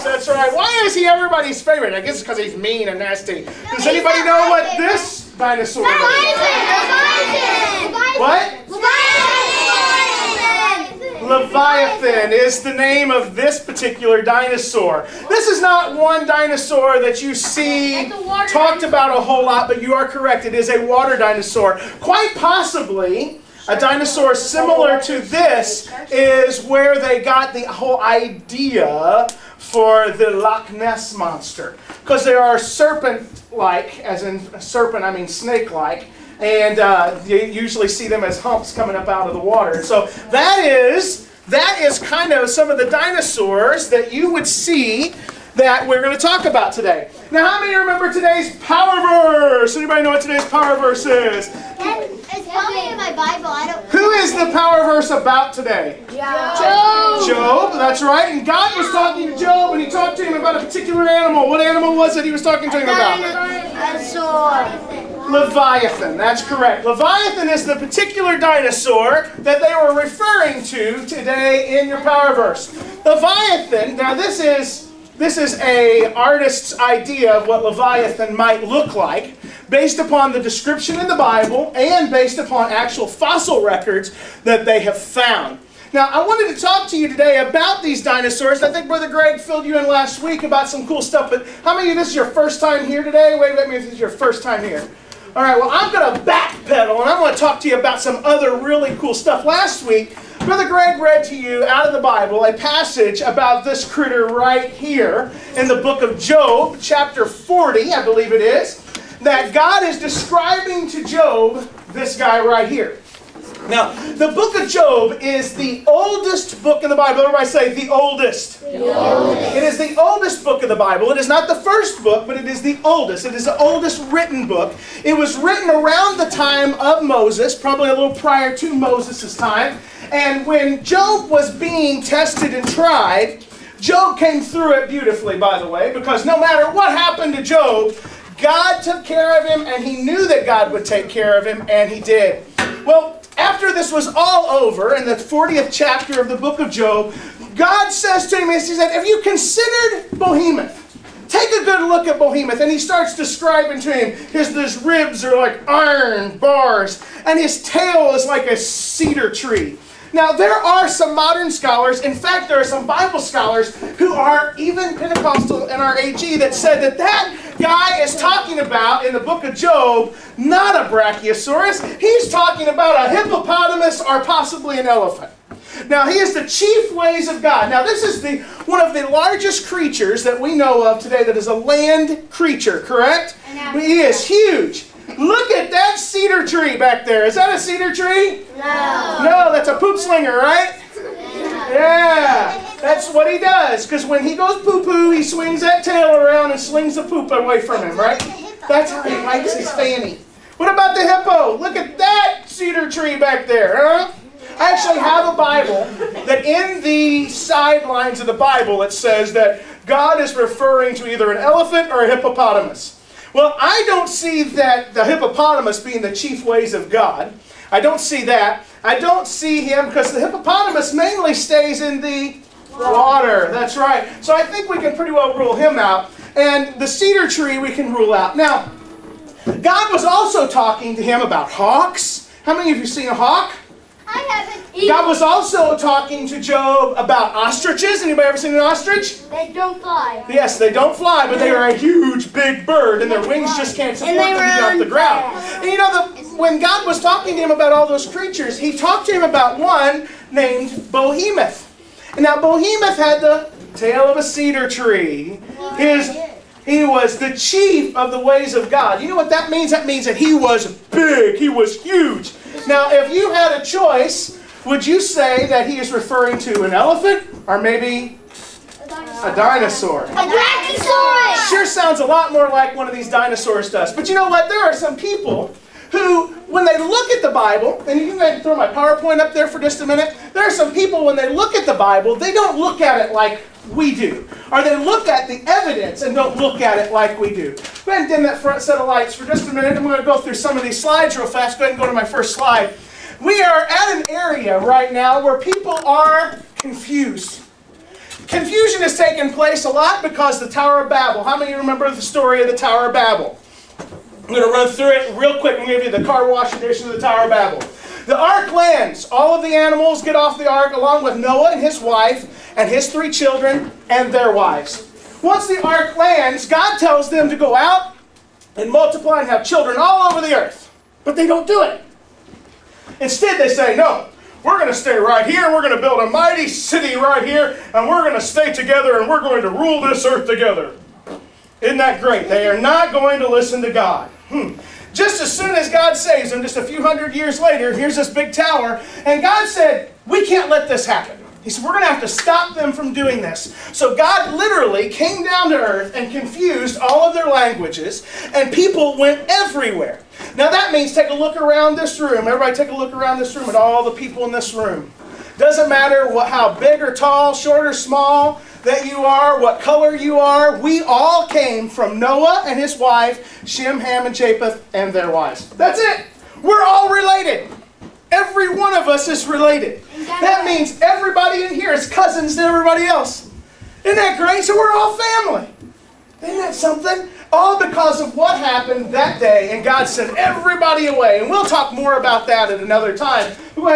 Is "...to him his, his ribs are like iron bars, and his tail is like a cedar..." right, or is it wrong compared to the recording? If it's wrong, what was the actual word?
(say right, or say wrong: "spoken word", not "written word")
right.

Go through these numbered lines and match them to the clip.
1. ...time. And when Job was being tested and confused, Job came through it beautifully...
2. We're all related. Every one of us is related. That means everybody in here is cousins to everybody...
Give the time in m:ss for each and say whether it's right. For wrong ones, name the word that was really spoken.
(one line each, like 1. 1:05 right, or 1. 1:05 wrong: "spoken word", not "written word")
1. 2:09 wrong: "tried", not "confused"
2. 6:06 right.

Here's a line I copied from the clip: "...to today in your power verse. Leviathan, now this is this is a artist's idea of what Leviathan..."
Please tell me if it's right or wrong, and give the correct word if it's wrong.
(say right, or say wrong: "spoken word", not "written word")
right.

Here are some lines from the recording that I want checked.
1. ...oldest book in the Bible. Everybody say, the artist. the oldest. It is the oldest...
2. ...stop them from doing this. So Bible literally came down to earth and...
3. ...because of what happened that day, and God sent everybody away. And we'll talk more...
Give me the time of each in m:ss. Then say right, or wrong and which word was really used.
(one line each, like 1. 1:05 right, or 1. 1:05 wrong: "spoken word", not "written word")
1. 1:55 wrong: "oldest", not "artist"
2. 5:42 wrong: "God", not "Bible"
3. 6:17 right.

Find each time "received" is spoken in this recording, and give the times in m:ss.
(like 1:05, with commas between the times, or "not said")
not said.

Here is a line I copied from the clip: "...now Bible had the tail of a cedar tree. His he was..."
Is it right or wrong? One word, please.
wrong.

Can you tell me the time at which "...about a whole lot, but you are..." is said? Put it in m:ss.
0:18.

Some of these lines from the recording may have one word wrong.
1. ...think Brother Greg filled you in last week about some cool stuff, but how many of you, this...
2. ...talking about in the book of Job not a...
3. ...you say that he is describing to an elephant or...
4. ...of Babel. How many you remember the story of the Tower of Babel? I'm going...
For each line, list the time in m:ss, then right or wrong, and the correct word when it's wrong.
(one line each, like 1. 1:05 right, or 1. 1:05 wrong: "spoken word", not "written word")
1. 1:28 right
2. 2:48 right
3. 4:24 wrong: "referring", not "describing"
4. 5:00 right.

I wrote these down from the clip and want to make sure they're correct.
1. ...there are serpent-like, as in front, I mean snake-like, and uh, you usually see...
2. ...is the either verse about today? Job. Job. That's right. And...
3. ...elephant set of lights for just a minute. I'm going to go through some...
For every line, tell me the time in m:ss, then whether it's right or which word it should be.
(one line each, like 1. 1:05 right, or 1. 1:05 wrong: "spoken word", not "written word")
1. 0:32 wrong: "serpent", not "front"
2. 0:54 wrong: "power", not "either"
3. 4:48 wrong: "front", not "elephant".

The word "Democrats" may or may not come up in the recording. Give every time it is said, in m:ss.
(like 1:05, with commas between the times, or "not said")
not said.